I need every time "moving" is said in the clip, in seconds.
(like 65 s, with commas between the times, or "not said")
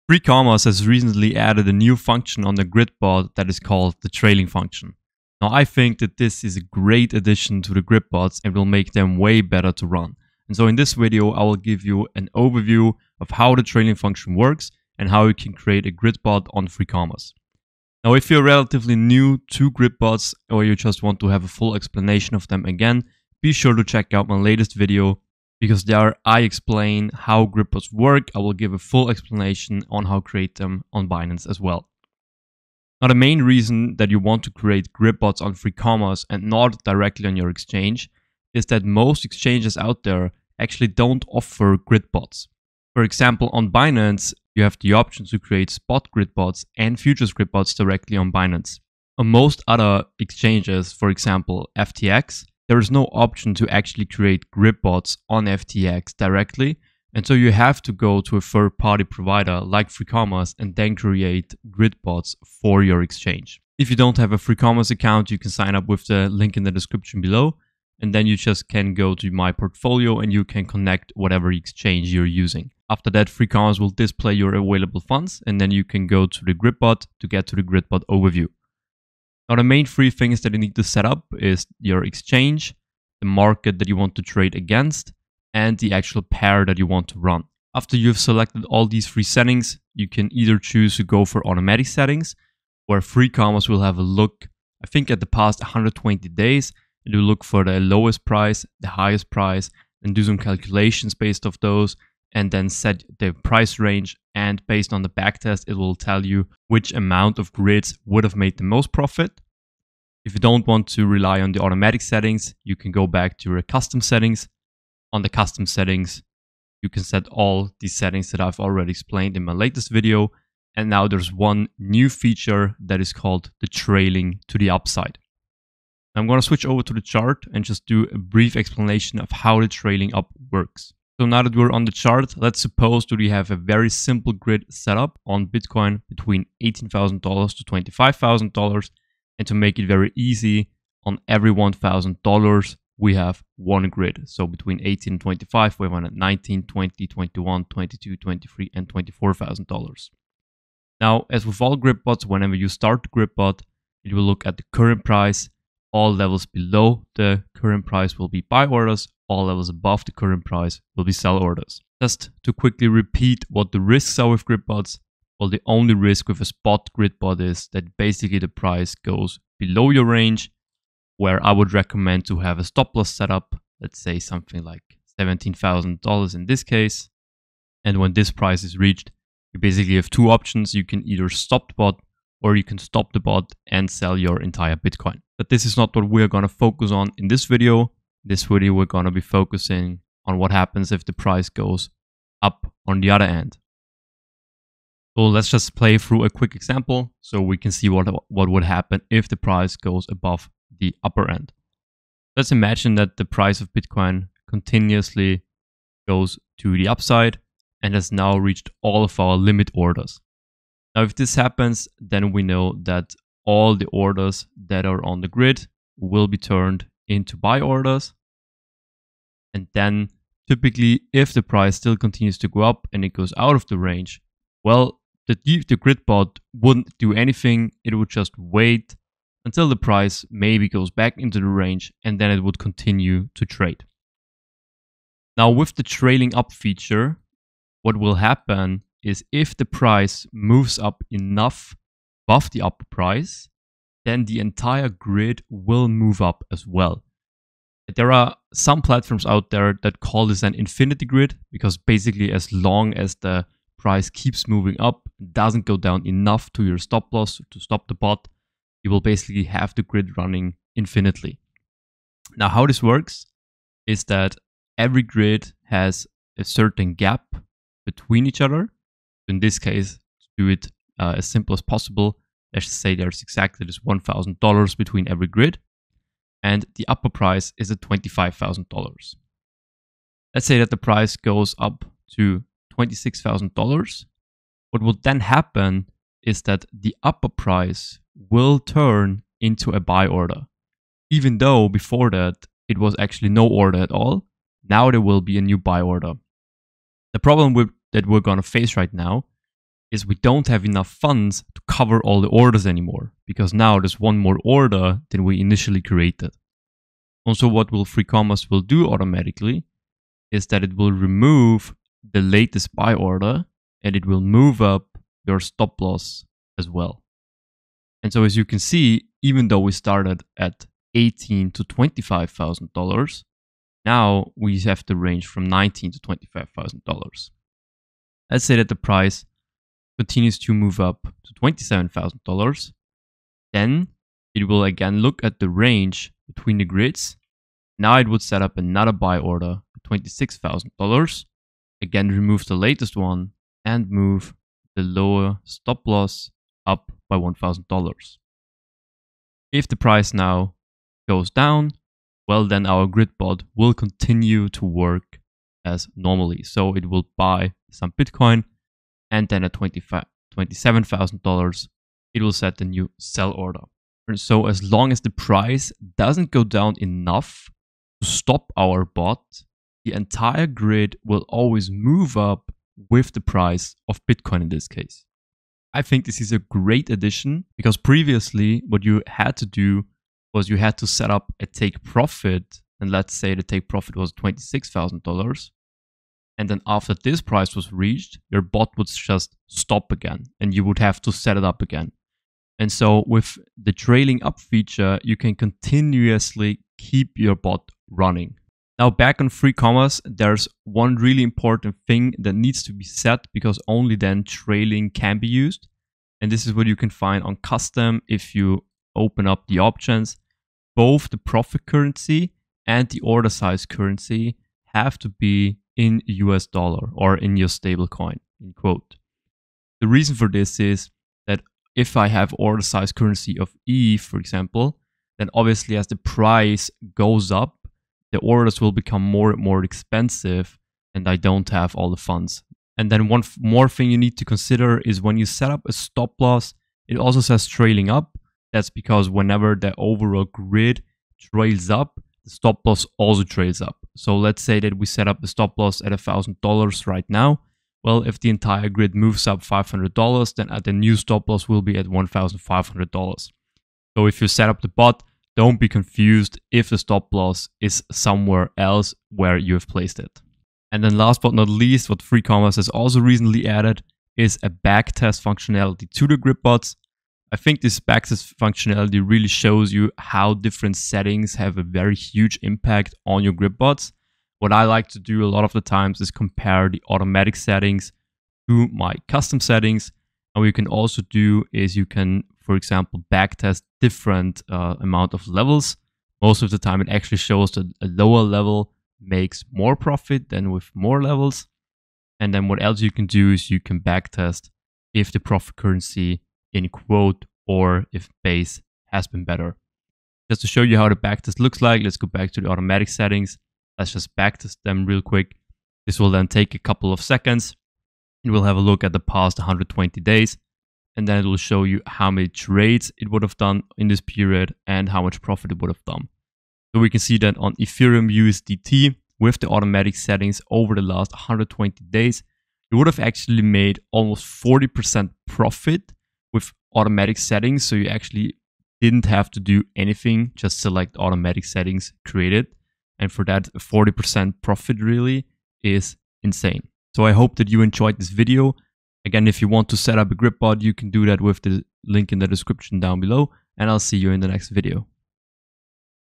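254 s.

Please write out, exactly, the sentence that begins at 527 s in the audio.
So you actually didn't have to do anything, just select automatic settings created.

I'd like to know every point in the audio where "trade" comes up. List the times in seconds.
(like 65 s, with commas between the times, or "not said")
84 s, 233 s, 512 s.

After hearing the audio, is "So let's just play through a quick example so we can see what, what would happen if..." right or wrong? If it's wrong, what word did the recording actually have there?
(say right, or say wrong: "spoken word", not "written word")
right.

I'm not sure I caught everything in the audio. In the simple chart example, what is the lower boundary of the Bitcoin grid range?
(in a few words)
$18,000.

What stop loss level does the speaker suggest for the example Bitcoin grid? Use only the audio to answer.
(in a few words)
$17,000.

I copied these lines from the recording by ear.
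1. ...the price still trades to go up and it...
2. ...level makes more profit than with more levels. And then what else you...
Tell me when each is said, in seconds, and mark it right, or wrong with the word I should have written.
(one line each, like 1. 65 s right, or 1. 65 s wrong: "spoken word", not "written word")
1. 221 s wrong: "continues", not "trades"
2. 488 s right.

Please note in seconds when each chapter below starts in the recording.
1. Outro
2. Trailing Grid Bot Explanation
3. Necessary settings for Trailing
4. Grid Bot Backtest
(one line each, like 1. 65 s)
1. 537 s
2. 130 s
3. 398 s
4. 461 s.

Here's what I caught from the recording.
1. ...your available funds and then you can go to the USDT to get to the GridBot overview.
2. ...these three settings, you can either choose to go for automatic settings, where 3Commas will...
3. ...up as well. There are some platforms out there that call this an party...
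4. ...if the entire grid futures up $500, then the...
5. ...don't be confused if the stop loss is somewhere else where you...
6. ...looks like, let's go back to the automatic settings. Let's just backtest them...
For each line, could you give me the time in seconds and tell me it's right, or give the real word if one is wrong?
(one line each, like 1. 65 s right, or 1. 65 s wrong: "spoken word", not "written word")
1. 74 s wrong: "GridBot", not "USDT"
2. 88 s right
3. 246 s wrong: "infinity", not "party"
4. 448 s wrong: "moves", not "futures"
5. 455 s right
6. 501 s right.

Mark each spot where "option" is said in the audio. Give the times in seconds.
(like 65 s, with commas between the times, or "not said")
44 s, 53 s, 180 s, 409 s.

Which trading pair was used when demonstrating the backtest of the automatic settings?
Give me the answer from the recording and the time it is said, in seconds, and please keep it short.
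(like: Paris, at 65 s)
Ethereum USDT, at 517 s.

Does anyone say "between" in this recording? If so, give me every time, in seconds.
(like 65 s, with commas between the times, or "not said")
136 s, 144 s, 267 s, 274 s, 336 s.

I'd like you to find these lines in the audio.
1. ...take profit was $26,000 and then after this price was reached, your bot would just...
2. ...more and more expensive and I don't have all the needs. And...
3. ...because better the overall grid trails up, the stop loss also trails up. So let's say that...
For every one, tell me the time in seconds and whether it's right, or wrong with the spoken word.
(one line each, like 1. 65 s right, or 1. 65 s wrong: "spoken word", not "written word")
1. 383 s right
2. 429 s wrong: "funds", not "needs"
3. 438 s wrong: "whenever", not "better".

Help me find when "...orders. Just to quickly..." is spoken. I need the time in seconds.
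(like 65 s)
161 s.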